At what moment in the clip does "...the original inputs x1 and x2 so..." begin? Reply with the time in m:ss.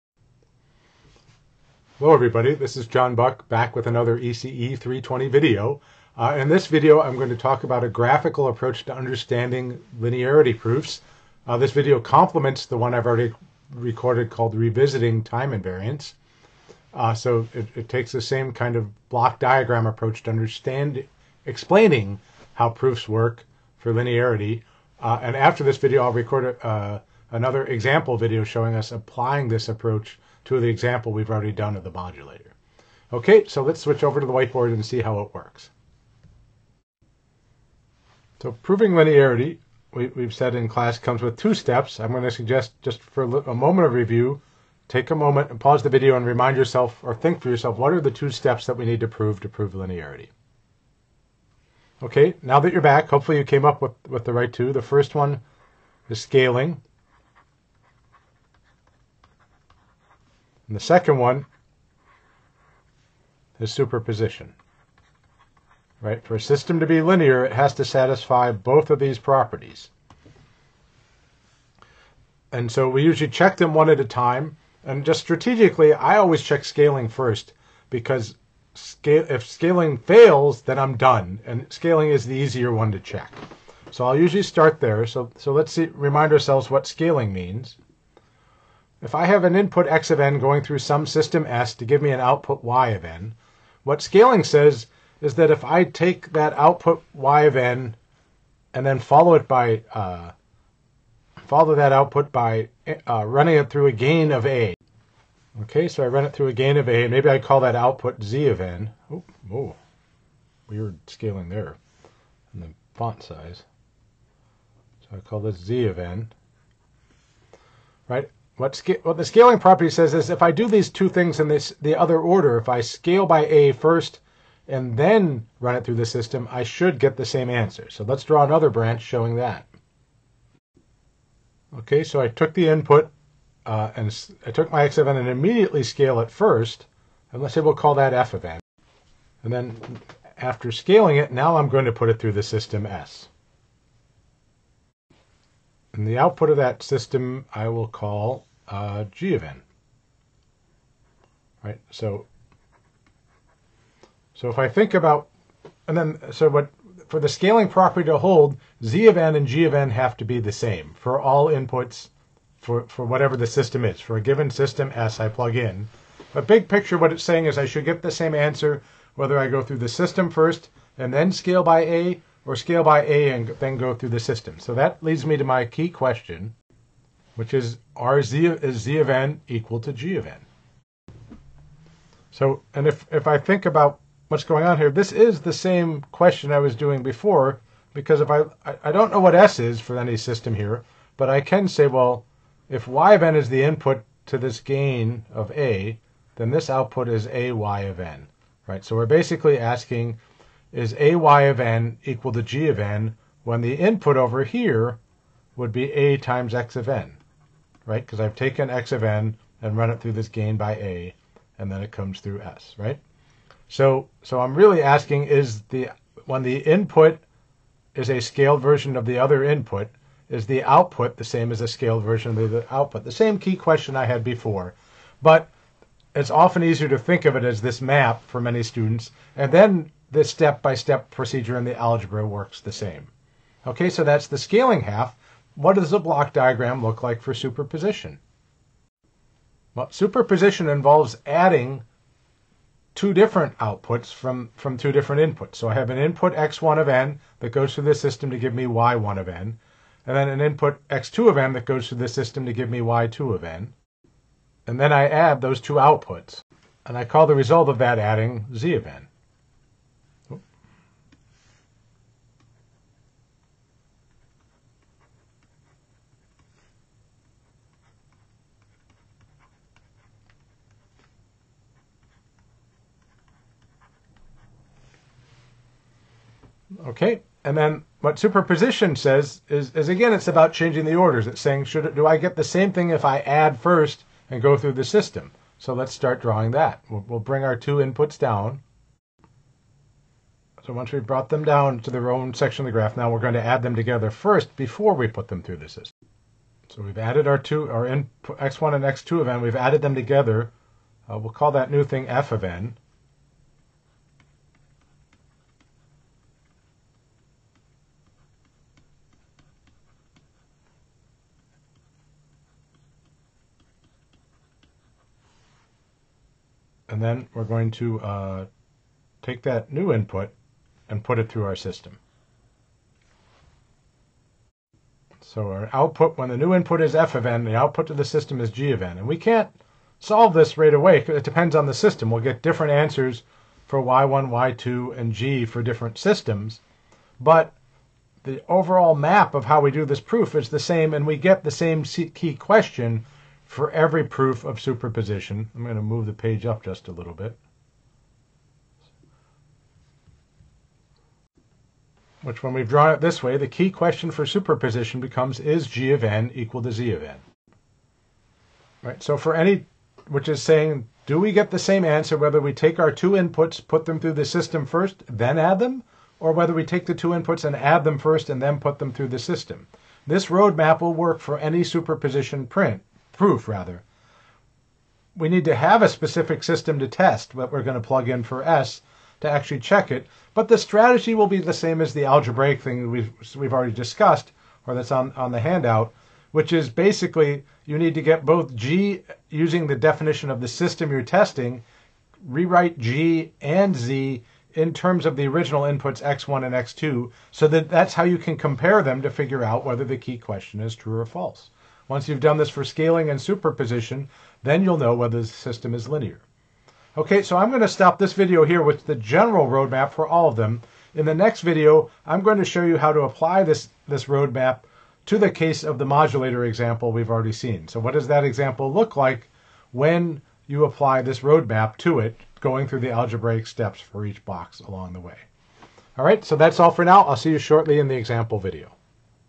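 6:35.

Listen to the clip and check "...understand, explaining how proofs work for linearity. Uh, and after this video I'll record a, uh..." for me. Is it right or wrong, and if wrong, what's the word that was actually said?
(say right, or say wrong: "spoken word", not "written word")
right.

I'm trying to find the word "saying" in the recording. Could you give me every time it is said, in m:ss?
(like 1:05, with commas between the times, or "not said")
2:47, 4:41, 6:00.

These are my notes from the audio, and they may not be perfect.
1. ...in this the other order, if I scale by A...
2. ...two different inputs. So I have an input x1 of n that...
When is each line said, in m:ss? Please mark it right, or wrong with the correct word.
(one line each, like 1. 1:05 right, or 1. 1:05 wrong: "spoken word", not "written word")
1. 2:01 right
2. 4:04 right.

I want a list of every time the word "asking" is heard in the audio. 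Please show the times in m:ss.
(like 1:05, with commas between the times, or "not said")
3:19, 3:34.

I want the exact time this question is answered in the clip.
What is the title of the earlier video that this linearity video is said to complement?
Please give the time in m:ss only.
0:14.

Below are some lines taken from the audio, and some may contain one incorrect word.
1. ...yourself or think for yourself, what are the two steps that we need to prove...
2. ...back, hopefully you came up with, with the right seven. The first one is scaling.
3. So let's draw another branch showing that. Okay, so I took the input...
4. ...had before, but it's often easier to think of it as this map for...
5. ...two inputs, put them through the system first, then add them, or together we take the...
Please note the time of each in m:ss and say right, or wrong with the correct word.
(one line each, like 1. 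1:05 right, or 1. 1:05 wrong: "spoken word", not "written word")
1. 0:46 right
2. 0:52 wrong: "two", not "seven"
3. 2:07 right
4. 3:44 right
5. 6:02 wrong: "whether", not "together".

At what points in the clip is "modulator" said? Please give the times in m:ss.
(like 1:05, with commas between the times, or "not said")
0:31, 6:55.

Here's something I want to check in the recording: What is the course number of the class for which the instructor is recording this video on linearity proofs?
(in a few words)
ECE 320.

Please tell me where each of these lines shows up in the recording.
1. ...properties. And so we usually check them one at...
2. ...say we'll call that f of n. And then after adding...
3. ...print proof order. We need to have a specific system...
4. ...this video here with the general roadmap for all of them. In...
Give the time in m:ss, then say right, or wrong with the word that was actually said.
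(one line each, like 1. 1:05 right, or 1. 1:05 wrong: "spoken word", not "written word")
1. 1:09 right
2. 2:17 wrong: "scaling", not "adding"
3. 6:12 wrong: "rather", not "order"
4. 6:47 right.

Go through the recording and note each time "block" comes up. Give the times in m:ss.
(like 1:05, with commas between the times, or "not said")
0:19, 3:55.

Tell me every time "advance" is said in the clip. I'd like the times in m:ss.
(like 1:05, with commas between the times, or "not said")
not said.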